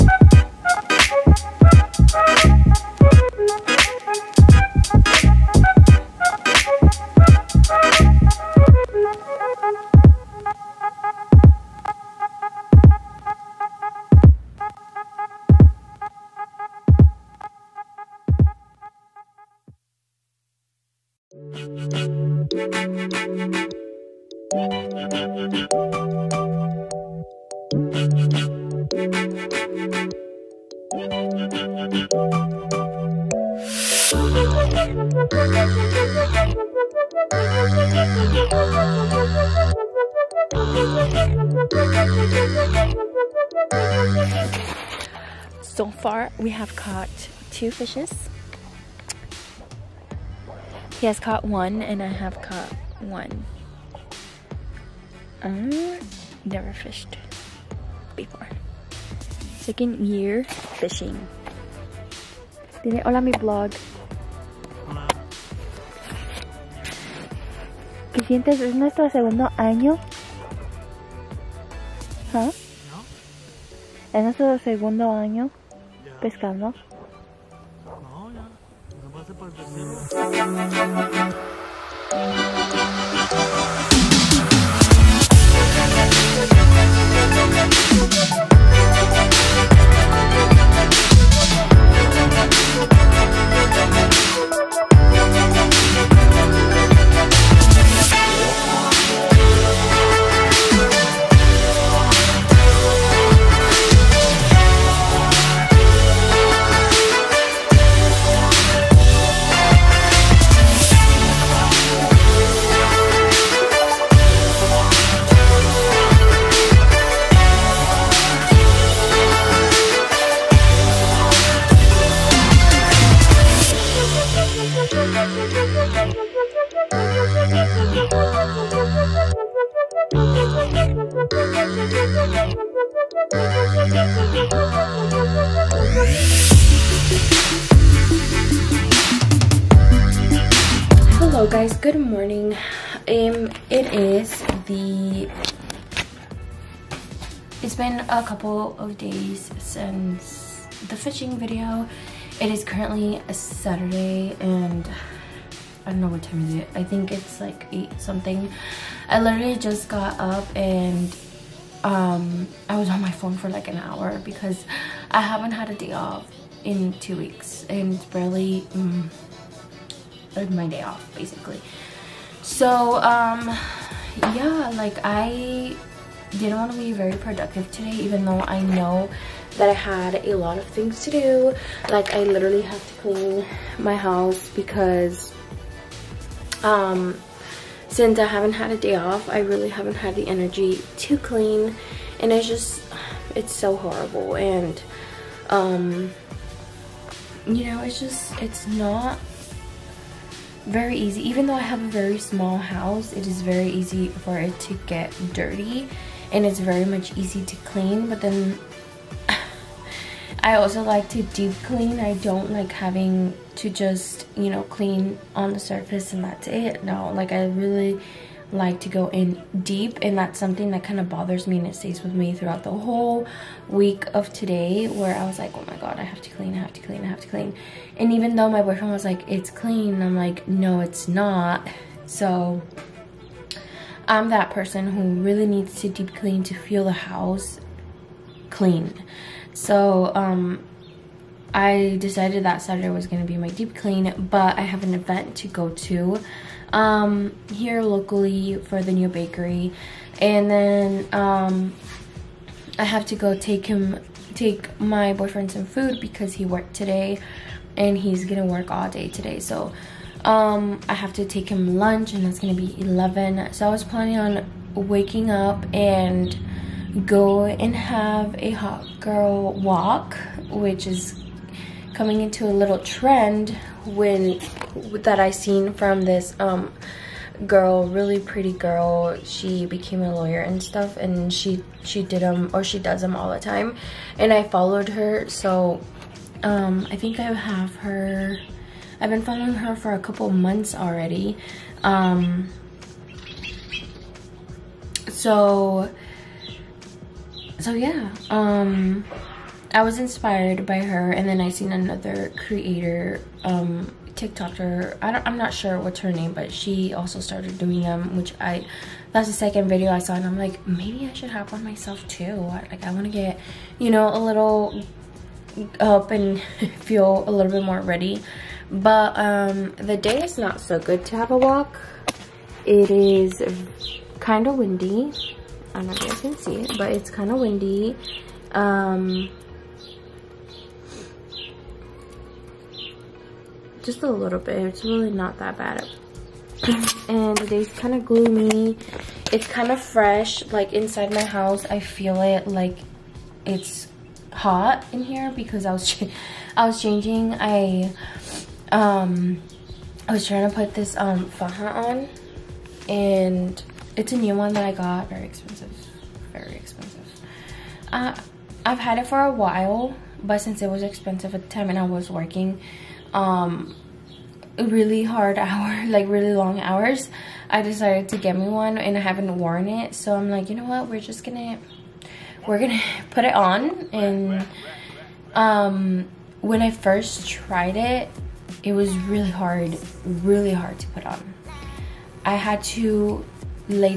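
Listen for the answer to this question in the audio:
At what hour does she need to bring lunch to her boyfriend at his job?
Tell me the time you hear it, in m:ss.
4:22.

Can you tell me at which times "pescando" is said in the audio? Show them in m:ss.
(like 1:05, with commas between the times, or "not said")
1:16.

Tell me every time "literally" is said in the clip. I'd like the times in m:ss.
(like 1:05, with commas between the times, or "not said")
2:39, 3:02.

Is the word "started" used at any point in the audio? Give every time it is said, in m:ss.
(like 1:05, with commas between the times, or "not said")
5:07.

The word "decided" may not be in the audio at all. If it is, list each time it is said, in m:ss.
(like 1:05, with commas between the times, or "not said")
4:01, 6:07.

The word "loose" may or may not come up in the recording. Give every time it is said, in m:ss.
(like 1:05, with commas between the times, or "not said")
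not said.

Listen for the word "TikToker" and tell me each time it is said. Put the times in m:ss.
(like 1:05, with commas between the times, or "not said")
5:04.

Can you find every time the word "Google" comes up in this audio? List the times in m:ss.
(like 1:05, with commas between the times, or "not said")
not said.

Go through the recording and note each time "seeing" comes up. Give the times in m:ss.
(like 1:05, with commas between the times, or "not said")
not said.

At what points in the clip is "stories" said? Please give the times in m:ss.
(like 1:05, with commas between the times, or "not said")
not said.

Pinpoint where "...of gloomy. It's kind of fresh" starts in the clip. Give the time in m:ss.
5:37.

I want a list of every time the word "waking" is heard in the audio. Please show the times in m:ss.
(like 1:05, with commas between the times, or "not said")
4:24.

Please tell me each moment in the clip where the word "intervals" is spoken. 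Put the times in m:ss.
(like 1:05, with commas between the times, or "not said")
not said.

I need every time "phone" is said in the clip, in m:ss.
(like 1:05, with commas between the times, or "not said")
2:43.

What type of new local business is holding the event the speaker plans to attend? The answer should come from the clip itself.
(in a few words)
bakery.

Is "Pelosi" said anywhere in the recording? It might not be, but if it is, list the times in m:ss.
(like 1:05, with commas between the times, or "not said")
not said.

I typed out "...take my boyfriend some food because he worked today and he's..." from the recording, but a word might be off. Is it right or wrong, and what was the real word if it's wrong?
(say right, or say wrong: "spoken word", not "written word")
right.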